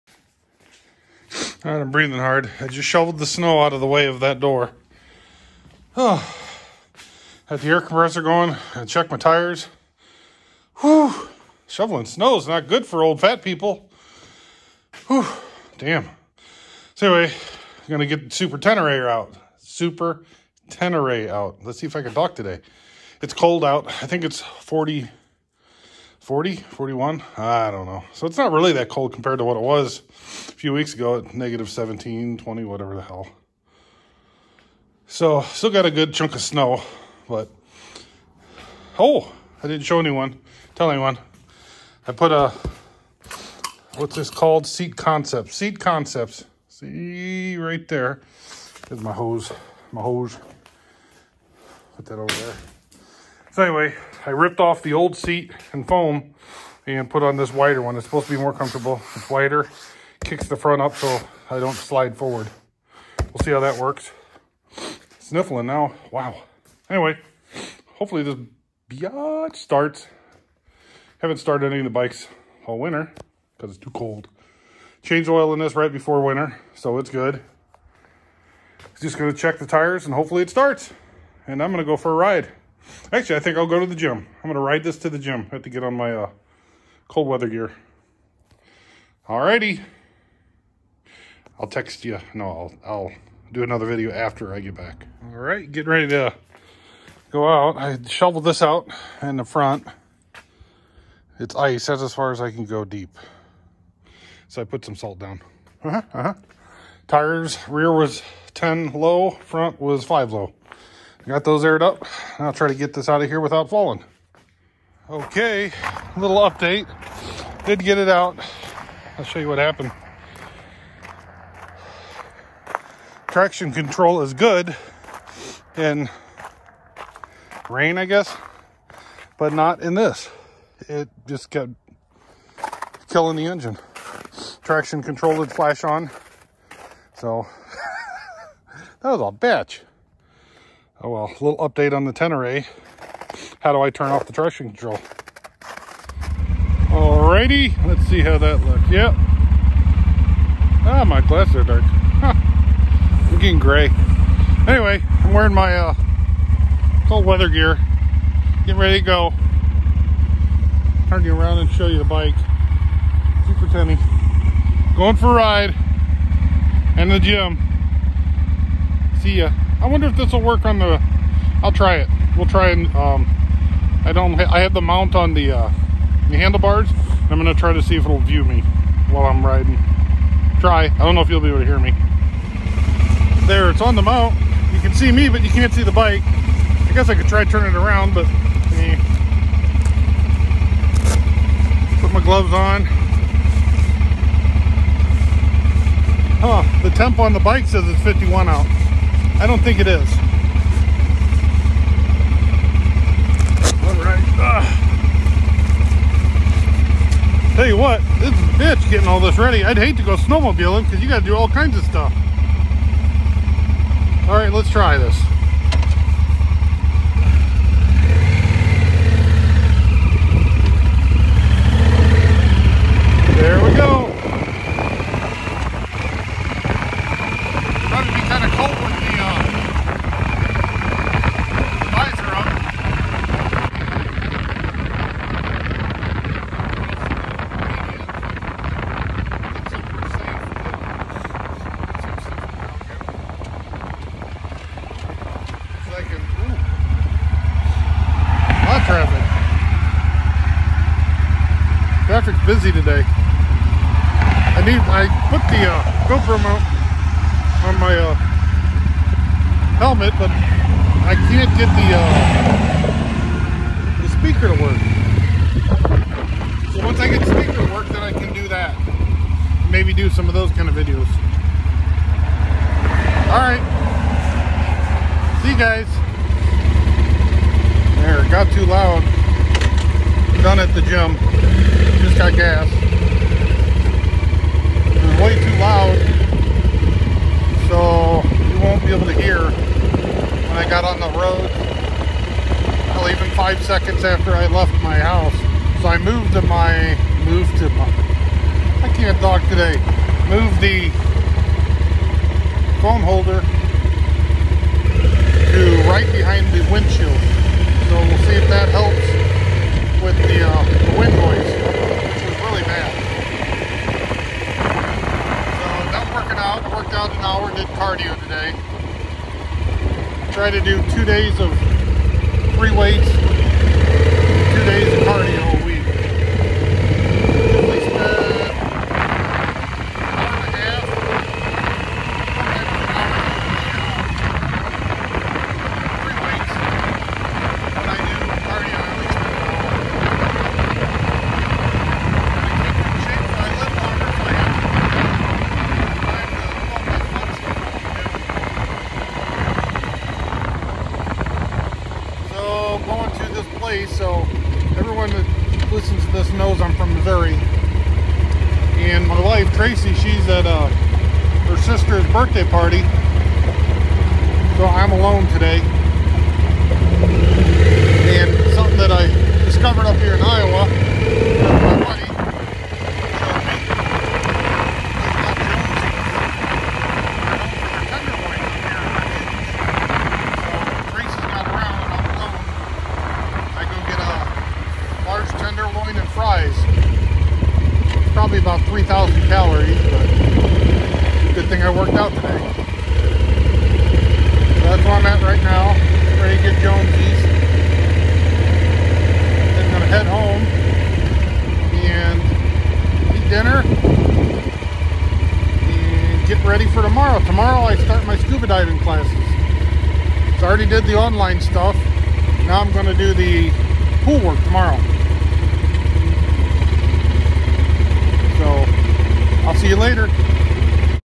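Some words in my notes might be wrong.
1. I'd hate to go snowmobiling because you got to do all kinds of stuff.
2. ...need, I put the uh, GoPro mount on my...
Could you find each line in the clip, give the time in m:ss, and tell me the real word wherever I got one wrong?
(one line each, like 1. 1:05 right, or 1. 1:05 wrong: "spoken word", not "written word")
1. 3:29 right
2. 4:14 right.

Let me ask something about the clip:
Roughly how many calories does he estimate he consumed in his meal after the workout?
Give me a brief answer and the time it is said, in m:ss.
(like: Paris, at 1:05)
3,000, at 6:29.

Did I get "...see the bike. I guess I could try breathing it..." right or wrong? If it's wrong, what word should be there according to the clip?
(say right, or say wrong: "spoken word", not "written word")
wrong: "turning", not "breathing".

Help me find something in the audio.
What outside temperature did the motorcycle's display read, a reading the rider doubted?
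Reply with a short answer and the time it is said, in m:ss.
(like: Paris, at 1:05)
51, at 3:18.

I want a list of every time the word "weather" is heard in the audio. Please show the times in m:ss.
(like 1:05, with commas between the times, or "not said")
1:27, 2:37.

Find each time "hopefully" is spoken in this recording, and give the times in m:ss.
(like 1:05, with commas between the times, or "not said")
1:07, 1:20.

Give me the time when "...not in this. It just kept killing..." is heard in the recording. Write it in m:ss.
2:09.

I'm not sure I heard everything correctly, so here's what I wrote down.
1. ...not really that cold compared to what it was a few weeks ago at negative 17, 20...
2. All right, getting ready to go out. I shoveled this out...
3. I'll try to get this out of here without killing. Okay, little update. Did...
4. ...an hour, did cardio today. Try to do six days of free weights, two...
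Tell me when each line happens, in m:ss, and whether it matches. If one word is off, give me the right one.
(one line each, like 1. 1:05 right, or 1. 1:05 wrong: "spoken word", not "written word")
1. 0:28 right
2. 1:35 right
3. 1:52 wrong: "falling", not "killing"
4. 5:17 wrong: "two", not "six".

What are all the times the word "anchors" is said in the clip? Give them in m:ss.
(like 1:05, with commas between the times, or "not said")
not said.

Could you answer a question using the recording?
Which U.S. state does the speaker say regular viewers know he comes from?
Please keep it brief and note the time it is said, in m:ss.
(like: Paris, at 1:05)
Missouri, at 5:56.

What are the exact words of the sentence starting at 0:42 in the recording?
I put a, what's this called?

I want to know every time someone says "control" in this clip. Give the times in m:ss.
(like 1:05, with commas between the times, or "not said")
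2:03, 2:15, 2:24.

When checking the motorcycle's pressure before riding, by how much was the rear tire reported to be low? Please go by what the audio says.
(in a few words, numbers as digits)
10.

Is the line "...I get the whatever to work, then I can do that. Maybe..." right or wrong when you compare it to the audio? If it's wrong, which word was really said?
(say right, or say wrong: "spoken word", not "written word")
wrong: "speaker", not "whatever".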